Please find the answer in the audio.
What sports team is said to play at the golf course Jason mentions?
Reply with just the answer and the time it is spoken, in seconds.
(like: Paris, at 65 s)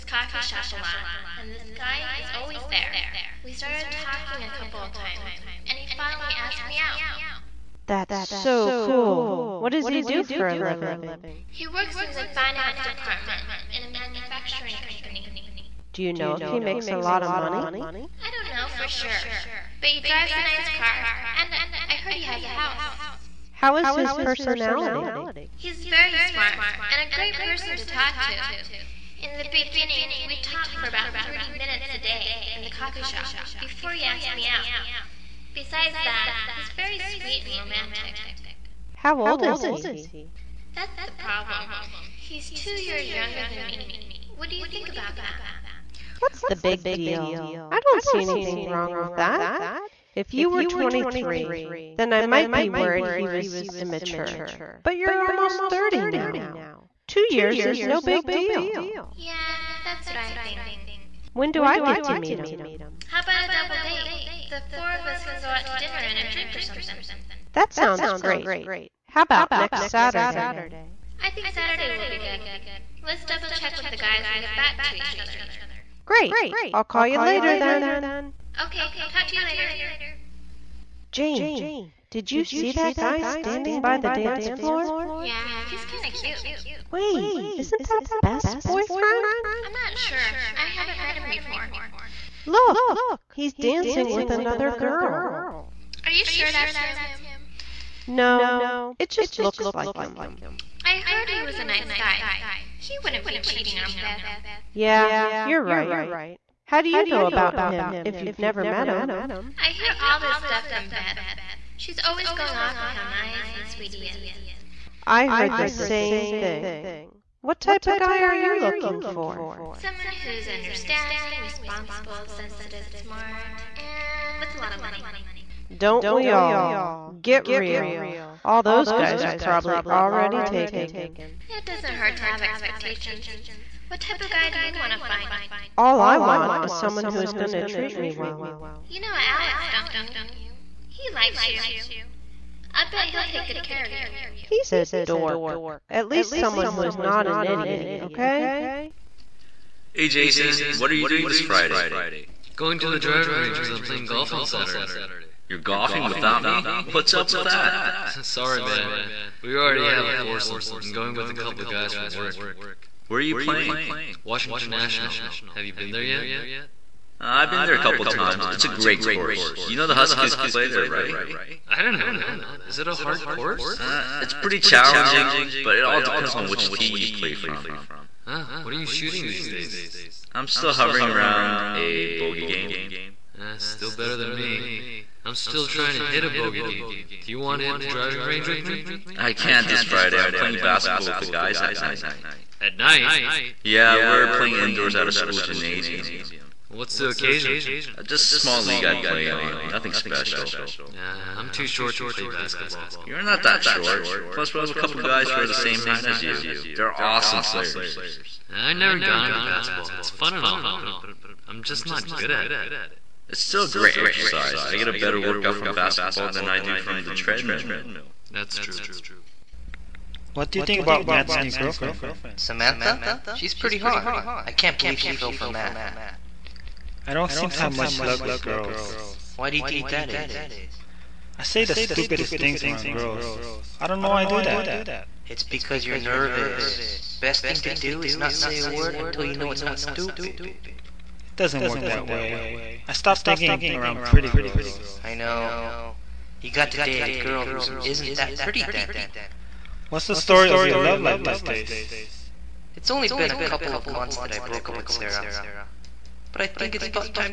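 The Huskies, at 169 s.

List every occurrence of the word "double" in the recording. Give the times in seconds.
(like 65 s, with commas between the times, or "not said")
63 s, 73 s.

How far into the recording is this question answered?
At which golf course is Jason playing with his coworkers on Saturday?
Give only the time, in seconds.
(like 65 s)
164 s.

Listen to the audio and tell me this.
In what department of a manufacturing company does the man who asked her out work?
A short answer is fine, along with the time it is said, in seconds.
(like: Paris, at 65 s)
Finance, at 12 s.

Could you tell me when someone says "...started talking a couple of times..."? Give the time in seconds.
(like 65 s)
3 s.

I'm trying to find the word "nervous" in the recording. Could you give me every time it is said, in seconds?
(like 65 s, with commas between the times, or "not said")
235 s.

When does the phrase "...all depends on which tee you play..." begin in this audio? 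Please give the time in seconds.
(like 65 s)
175 s.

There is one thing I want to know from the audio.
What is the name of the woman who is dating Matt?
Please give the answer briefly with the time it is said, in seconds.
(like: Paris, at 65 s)
Samantha, at 222 s.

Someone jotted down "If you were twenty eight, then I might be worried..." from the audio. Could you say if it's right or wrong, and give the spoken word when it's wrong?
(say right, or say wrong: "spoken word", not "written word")
wrong: "three", not "eight".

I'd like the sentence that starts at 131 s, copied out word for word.
It doesn't hurt to have expectations.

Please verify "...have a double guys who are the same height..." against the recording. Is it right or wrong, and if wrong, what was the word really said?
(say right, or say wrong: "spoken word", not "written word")
wrong: "couple", not "double".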